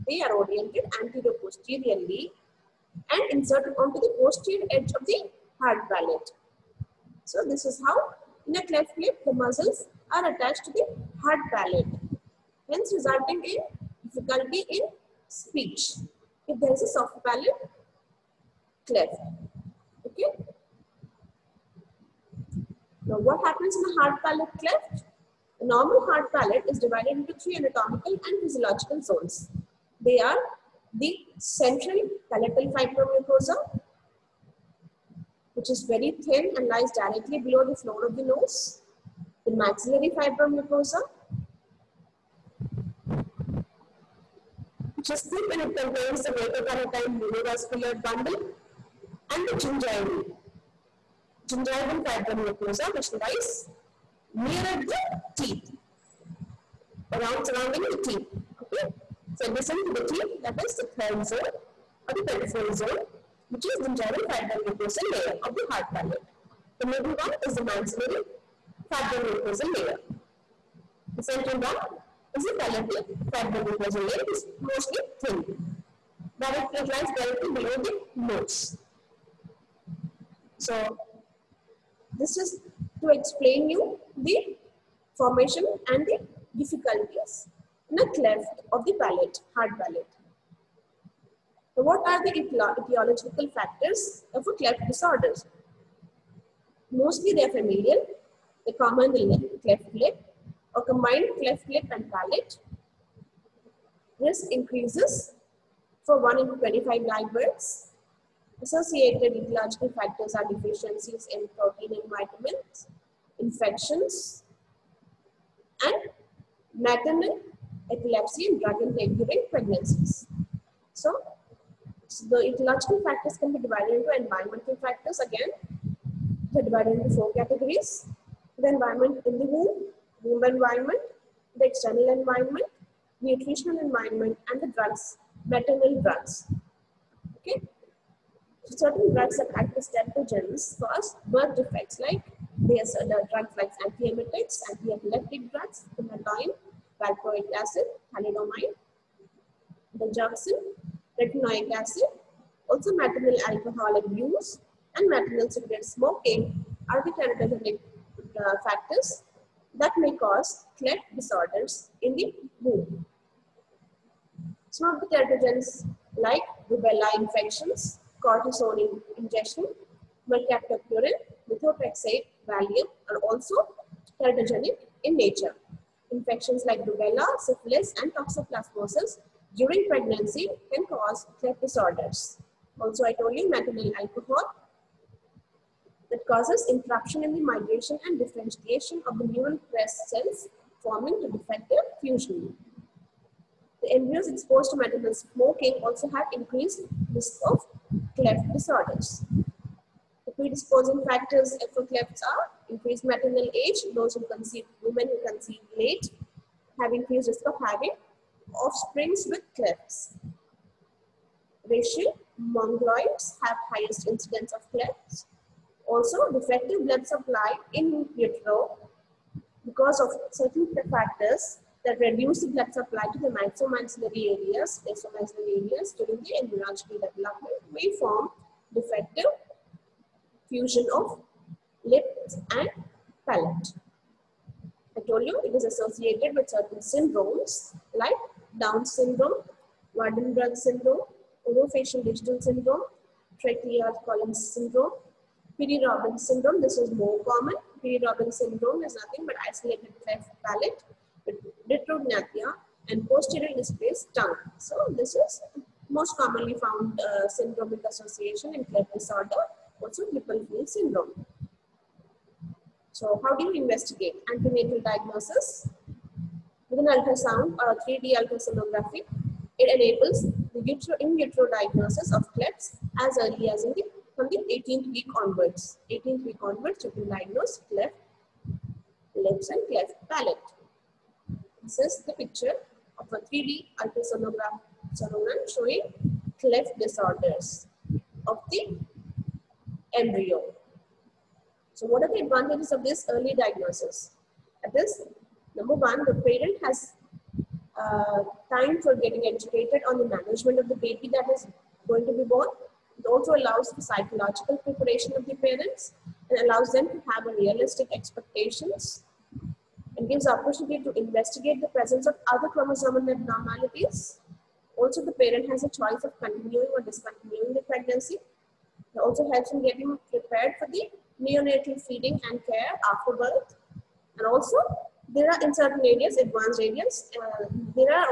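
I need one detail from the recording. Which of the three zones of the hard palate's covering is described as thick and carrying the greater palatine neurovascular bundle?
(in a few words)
maxillary fibromucosa.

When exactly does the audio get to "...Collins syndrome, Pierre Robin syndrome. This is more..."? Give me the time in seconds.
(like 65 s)
244 s.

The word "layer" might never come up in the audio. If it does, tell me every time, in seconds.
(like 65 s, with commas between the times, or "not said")
65 s, 69 s, 73 s.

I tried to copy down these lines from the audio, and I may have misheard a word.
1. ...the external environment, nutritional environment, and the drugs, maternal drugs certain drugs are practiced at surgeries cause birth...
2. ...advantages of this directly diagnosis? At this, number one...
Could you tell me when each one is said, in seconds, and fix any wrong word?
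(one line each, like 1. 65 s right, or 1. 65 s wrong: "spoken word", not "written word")
1. 131 s right
2. 292 s wrong: "early", not "directly".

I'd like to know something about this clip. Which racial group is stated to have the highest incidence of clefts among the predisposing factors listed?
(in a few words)
Mongoloids.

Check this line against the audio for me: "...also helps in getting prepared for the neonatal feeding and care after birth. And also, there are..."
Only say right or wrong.
right.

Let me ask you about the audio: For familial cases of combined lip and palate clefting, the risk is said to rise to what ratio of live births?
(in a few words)
1 in 25.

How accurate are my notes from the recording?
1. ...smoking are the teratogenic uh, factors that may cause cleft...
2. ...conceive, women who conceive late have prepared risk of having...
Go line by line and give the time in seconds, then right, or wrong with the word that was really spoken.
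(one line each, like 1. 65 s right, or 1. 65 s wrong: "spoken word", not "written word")
1. 155 s right
2. 204 s wrong: "increased", not "prepared".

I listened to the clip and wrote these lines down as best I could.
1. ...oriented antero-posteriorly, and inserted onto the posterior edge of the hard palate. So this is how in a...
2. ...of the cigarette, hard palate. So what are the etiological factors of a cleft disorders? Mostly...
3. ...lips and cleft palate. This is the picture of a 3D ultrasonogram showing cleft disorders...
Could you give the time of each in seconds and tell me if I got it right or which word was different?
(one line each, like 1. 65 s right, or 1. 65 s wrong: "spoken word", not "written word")
1. 0 s right
2. 88 s wrong: "palate", not "cigarette"
3. 279 s right.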